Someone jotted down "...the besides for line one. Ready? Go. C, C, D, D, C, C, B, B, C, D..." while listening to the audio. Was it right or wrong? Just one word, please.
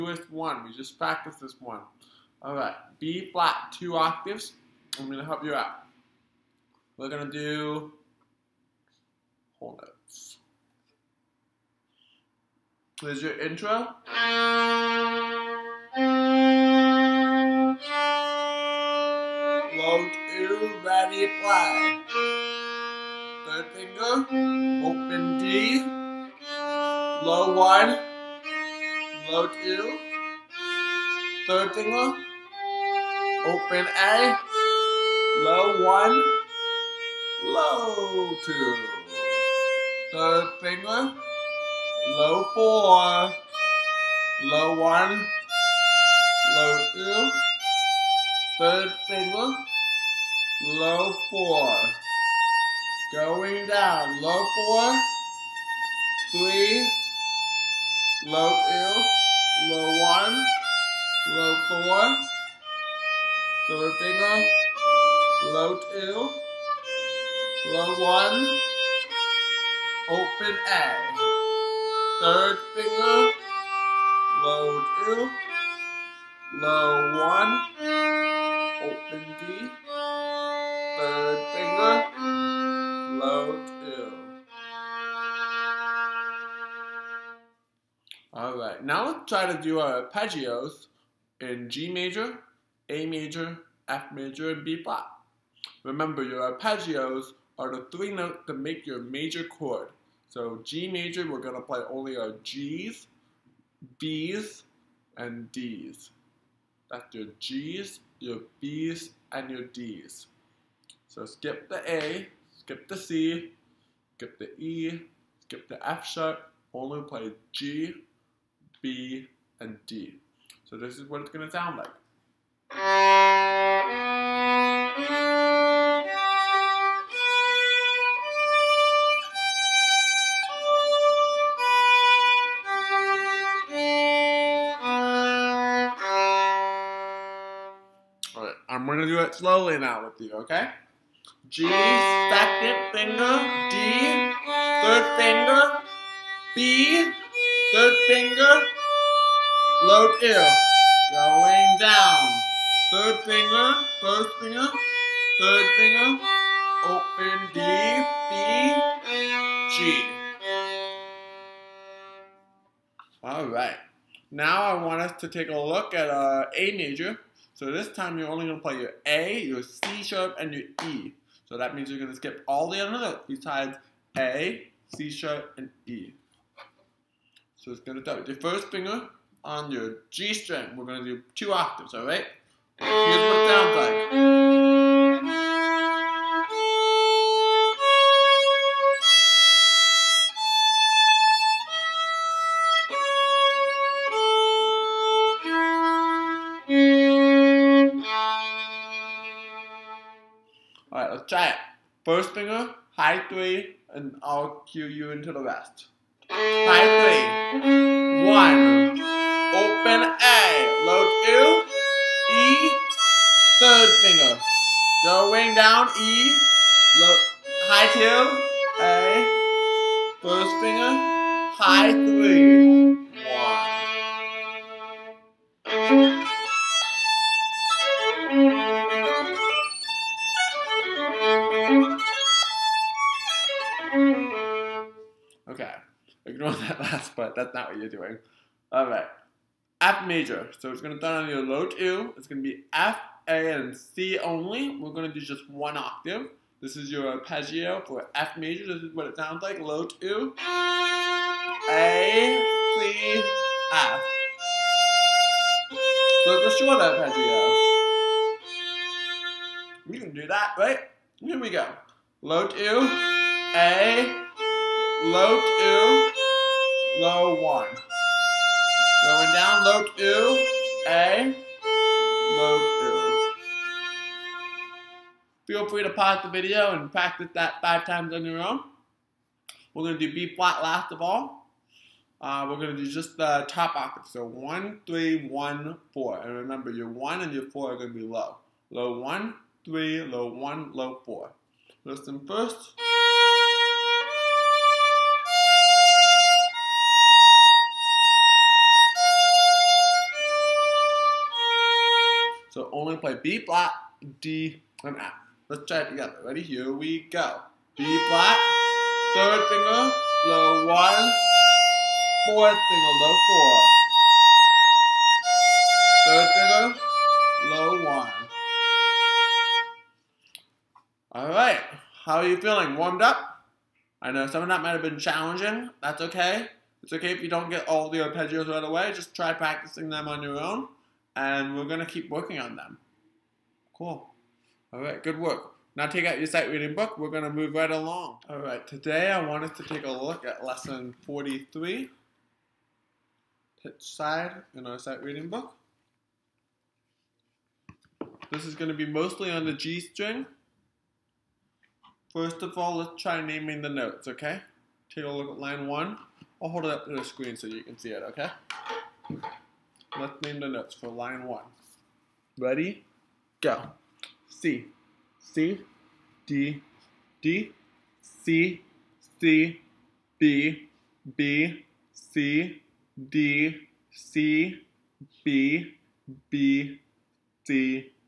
wrong.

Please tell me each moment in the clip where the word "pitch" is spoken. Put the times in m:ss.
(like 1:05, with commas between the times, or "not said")
5:43.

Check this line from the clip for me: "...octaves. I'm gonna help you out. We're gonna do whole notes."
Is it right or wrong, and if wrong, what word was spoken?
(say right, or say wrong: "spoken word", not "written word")
right.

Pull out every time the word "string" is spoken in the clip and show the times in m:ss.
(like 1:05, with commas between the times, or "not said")
3:00, 5:49.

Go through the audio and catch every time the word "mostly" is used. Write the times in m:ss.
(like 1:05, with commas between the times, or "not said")
5:48.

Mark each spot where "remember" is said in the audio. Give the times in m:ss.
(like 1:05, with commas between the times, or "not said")
1:35, 4:46.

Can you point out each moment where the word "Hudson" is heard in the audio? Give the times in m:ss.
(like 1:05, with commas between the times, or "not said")
not said.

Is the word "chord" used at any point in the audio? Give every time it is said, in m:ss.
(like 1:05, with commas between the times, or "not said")
1:39.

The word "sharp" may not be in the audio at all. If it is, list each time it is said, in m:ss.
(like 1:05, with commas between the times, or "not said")
1:56, 2:50, 2:55.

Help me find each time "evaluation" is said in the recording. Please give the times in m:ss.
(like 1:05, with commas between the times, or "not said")
not said.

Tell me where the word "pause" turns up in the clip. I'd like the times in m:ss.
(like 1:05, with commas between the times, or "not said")
4:35.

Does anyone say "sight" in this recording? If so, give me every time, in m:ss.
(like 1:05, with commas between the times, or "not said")
5:36, 5:44.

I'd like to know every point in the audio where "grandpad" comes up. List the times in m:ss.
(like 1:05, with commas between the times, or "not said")
not said.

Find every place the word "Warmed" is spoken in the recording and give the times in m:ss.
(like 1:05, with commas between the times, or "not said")
5:22.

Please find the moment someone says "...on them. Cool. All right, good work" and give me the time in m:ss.
5:32.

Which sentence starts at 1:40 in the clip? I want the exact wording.
So G major, we're gonna play only our Gs, Bs, and Ds.